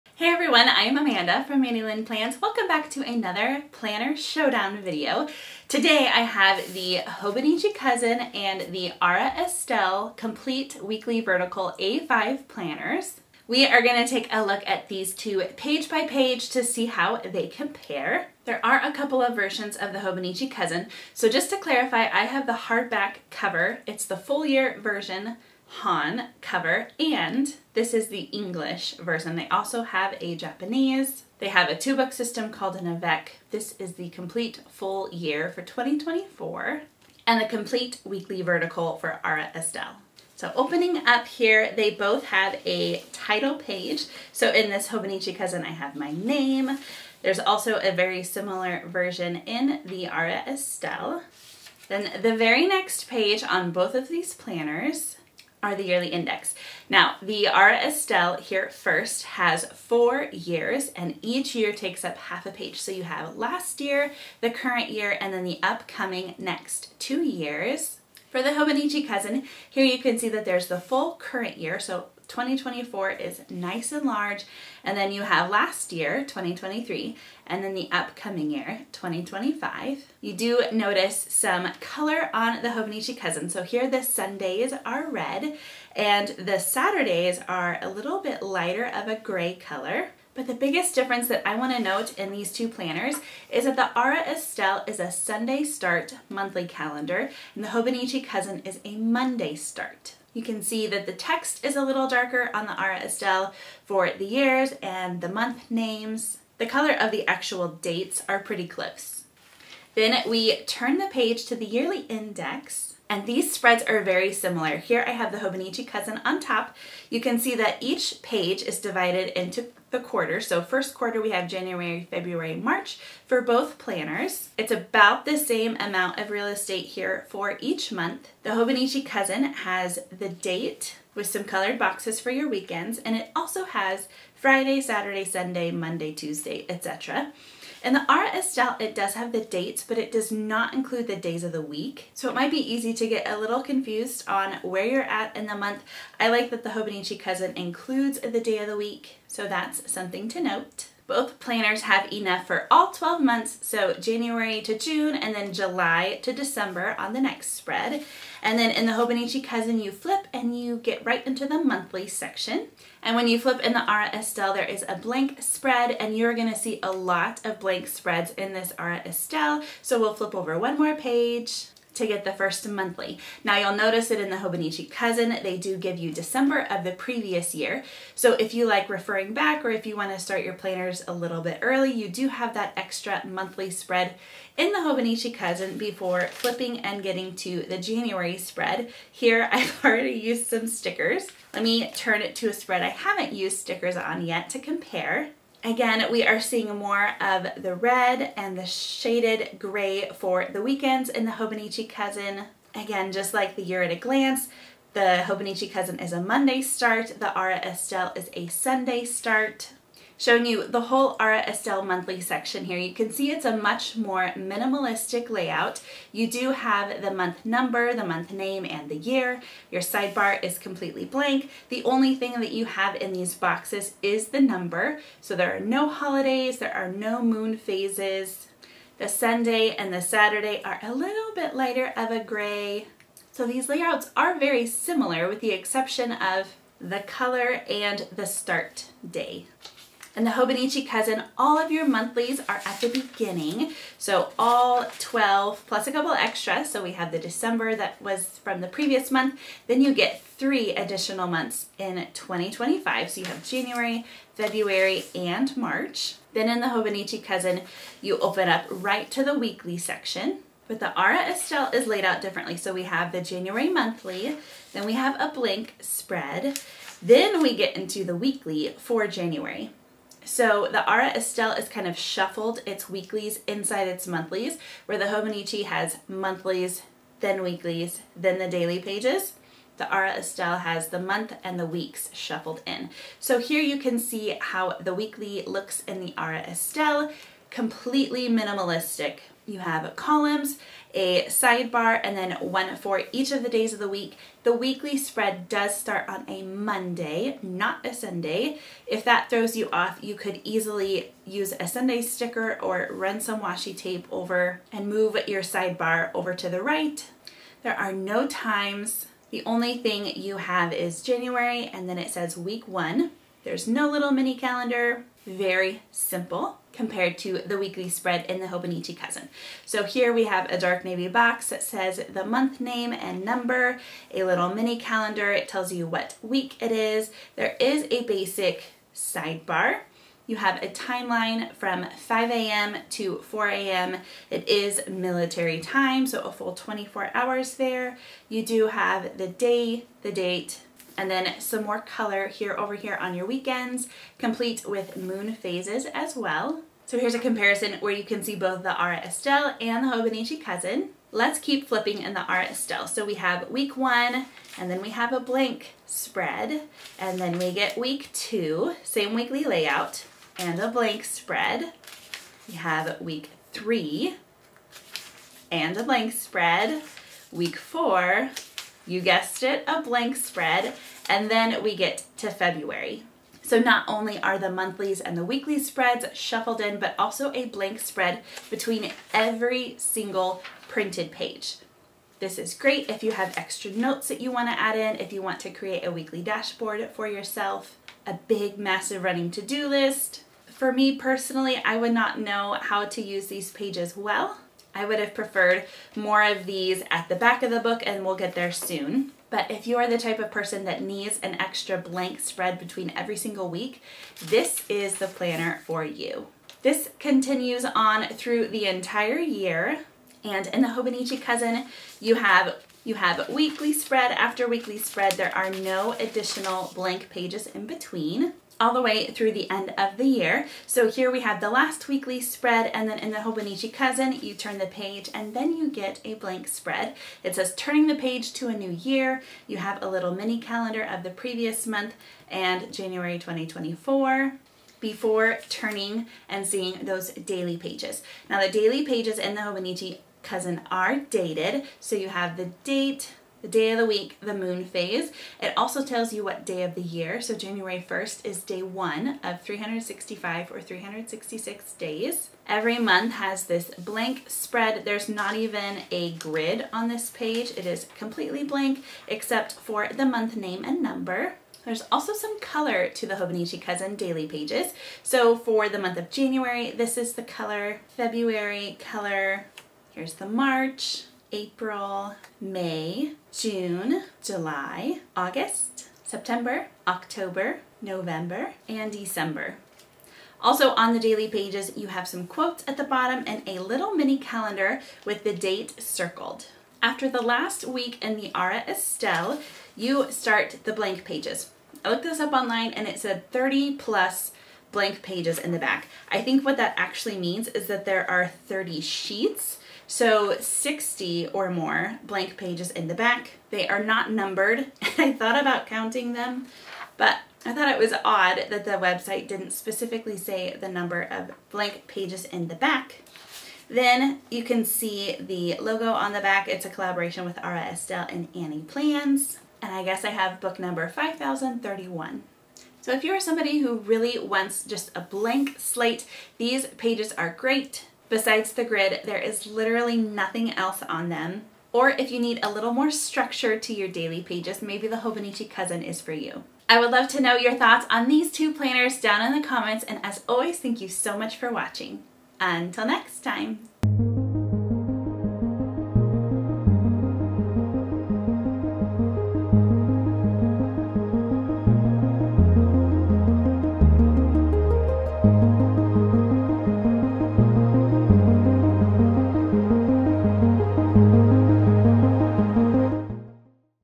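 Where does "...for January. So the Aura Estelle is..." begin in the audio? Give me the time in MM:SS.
04:28.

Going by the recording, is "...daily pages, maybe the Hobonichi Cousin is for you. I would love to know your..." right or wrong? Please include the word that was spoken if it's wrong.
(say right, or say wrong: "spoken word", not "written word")
right.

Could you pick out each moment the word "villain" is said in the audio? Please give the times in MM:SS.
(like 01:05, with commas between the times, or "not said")
not said.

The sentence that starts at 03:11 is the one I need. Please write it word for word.
Let me turn it to a spread I haven't used stickers on yet to compare.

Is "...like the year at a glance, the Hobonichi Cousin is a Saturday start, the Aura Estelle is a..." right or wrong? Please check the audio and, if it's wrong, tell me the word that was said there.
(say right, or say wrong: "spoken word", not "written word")
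wrong: "Monday", not "Saturday".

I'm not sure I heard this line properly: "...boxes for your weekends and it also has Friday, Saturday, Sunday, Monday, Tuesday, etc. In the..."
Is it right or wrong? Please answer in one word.
right.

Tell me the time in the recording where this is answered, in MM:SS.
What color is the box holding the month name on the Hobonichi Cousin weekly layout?
05:20.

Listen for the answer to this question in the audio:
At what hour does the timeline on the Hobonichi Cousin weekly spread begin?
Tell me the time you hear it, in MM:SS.
05:31.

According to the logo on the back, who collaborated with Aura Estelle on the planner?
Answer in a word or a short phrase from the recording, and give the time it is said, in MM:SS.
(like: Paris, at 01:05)
Annie Plans, at 08:38.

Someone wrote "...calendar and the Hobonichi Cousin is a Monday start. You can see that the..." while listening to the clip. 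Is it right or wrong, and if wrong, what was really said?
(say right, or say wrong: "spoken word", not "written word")
right.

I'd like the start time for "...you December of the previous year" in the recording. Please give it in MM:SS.
02:55.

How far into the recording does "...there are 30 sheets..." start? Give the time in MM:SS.
08:17.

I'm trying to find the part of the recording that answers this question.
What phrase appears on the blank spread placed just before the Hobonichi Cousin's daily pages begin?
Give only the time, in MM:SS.
07:07.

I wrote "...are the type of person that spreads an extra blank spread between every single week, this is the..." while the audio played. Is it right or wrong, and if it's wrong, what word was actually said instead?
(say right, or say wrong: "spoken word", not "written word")
wrong: "needs", not "spreads".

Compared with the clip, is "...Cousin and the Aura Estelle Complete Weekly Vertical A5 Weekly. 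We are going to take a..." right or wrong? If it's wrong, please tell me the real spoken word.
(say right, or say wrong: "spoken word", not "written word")
wrong: "Planners", not "Weekly".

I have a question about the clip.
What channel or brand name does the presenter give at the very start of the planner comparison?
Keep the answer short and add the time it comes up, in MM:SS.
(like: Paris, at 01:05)
Mandy Lynn Plans, at 00:01.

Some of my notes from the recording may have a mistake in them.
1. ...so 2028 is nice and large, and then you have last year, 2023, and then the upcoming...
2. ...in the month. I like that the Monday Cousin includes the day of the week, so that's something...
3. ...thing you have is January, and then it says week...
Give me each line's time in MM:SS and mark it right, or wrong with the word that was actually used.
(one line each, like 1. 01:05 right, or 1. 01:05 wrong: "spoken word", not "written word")
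1. 01:11 wrong: "2024", not "2028"
2. 02:25 wrong: "Hobonichi", not "Monday"
3. 05:09 right.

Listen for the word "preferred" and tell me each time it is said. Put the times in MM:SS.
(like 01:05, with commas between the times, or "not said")
06:35.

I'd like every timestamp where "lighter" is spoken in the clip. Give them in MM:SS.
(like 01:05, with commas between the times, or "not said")
01:28, 03:51.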